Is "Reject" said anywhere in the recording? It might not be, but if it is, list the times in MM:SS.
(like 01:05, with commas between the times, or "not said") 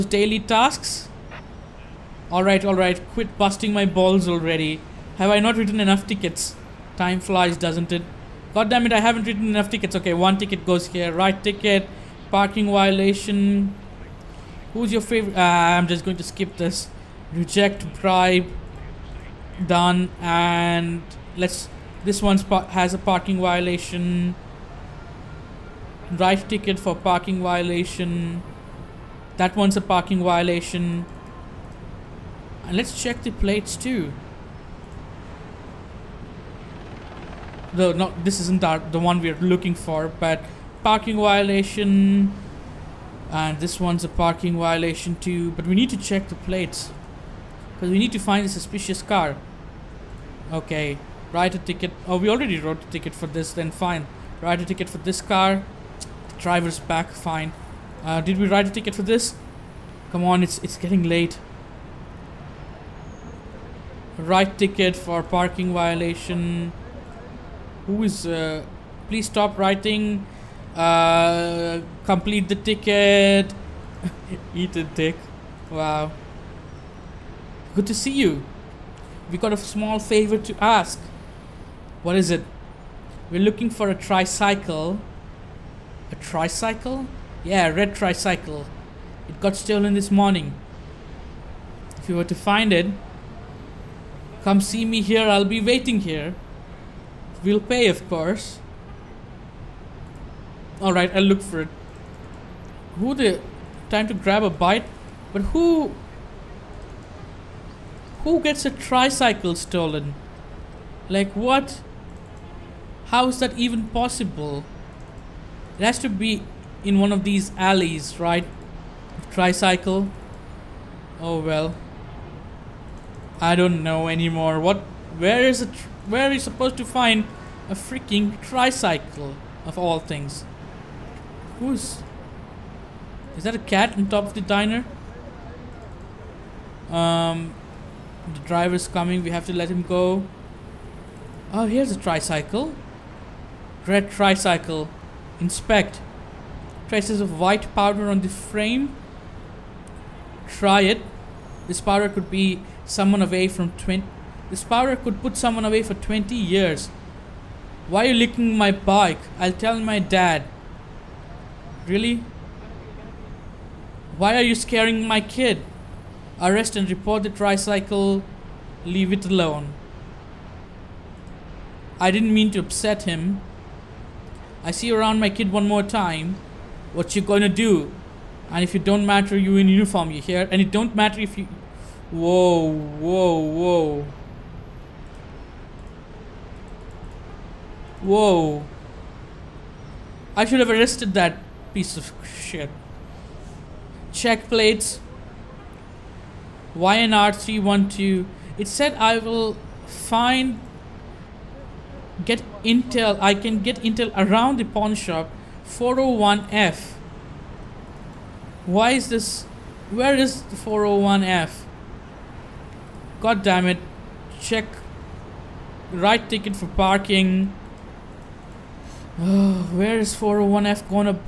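00:17.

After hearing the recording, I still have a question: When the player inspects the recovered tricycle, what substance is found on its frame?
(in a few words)
White powder.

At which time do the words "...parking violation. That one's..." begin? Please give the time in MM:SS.
00:26.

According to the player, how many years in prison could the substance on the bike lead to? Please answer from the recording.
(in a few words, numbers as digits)
20.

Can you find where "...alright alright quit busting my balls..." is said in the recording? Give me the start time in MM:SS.
00:02.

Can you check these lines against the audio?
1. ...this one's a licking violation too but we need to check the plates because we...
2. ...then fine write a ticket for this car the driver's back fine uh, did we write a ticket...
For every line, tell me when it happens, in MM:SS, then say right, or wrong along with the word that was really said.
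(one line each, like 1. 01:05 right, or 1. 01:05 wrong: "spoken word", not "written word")
1. 00:43 wrong: "parking", not "licking"
2. 00:53 right.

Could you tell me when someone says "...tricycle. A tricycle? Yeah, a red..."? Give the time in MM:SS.
01:23.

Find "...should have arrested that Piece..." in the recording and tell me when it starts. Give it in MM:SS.
03:10.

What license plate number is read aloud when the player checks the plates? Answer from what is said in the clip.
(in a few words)
YNR312.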